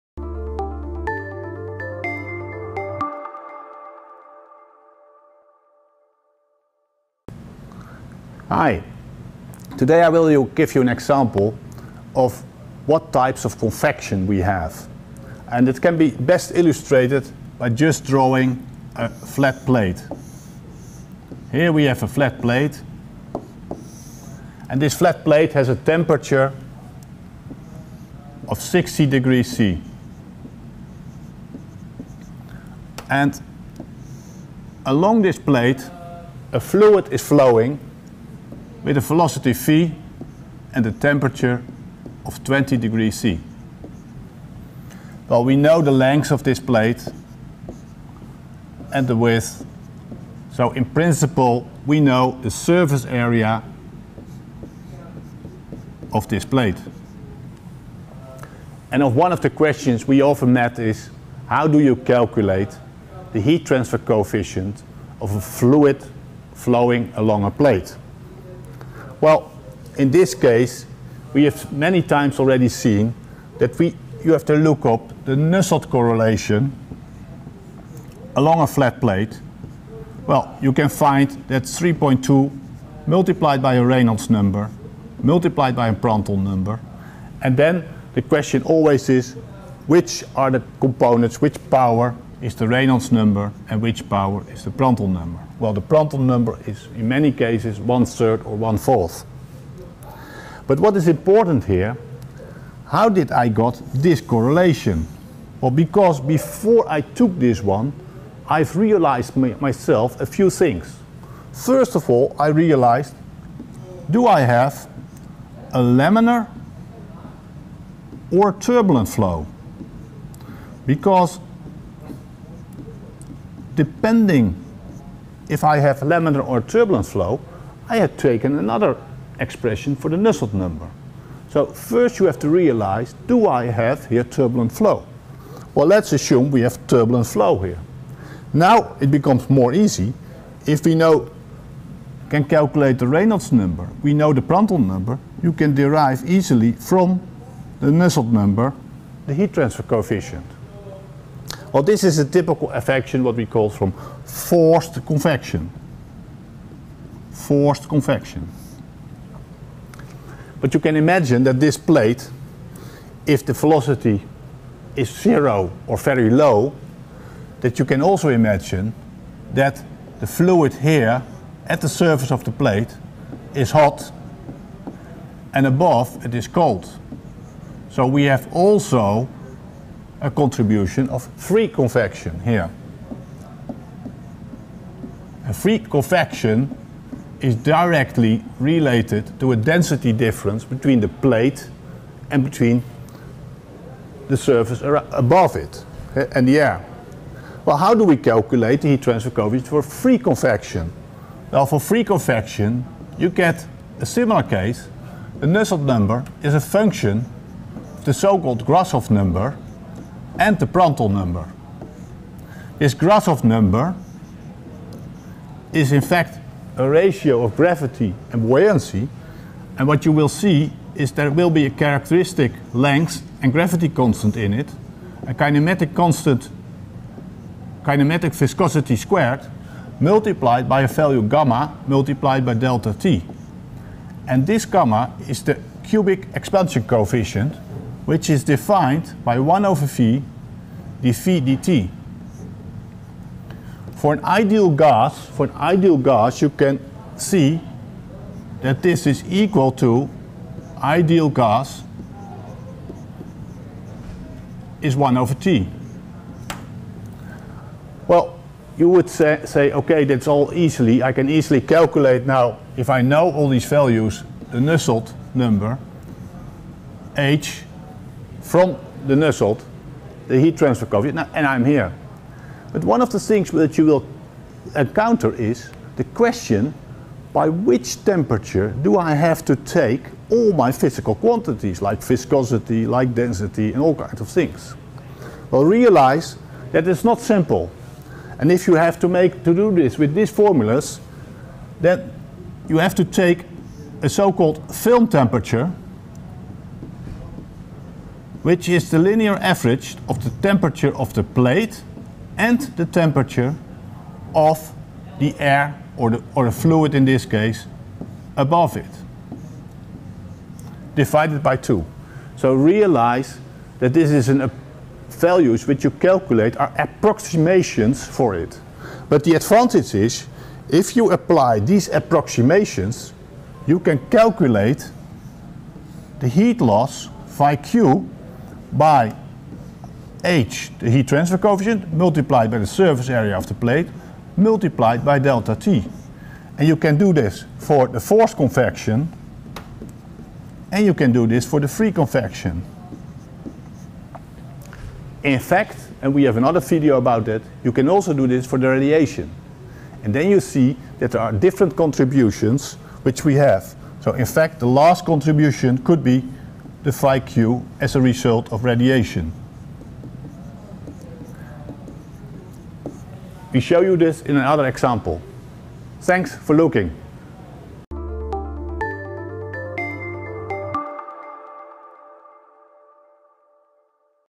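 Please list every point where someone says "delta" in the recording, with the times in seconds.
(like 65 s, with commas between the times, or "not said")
232 s, 335 s.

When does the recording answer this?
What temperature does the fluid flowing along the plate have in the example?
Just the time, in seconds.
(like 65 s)
42 s.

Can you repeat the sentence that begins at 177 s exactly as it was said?
So we have also a contribution of free convection here.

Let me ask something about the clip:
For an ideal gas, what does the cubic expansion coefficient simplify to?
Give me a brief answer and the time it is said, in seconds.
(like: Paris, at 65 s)
1 over T, at 254 s.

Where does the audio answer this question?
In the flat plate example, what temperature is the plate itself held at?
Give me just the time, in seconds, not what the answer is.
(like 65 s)
28 s.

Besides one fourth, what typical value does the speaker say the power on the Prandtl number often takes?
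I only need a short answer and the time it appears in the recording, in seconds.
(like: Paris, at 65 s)
one third, at 97 s.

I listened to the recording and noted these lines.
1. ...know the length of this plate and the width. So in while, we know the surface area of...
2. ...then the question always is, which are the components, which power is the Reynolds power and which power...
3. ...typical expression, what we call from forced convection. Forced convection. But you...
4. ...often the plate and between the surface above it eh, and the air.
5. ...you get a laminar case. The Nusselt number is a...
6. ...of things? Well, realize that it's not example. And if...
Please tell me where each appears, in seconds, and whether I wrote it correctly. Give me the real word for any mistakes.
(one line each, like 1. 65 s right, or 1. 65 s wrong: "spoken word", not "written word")
1. 45 s wrong: "principle", not "while"
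2. 87 s wrong: "number", not "power"
3. 152 s wrong: "affection", not "expression"
4. 190 s wrong: "between", not "often"
5. 203 s wrong: "similar", not "laminar"
6. 284 s wrong: "simple", not "example".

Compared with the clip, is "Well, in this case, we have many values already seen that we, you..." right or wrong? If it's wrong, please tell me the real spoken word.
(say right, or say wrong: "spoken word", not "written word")
wrong: "times", not "values".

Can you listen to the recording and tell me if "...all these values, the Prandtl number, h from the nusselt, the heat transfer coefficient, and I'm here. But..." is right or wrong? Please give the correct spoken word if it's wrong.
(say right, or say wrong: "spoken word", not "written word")
wrong: "Nusselt", not "Prandtl".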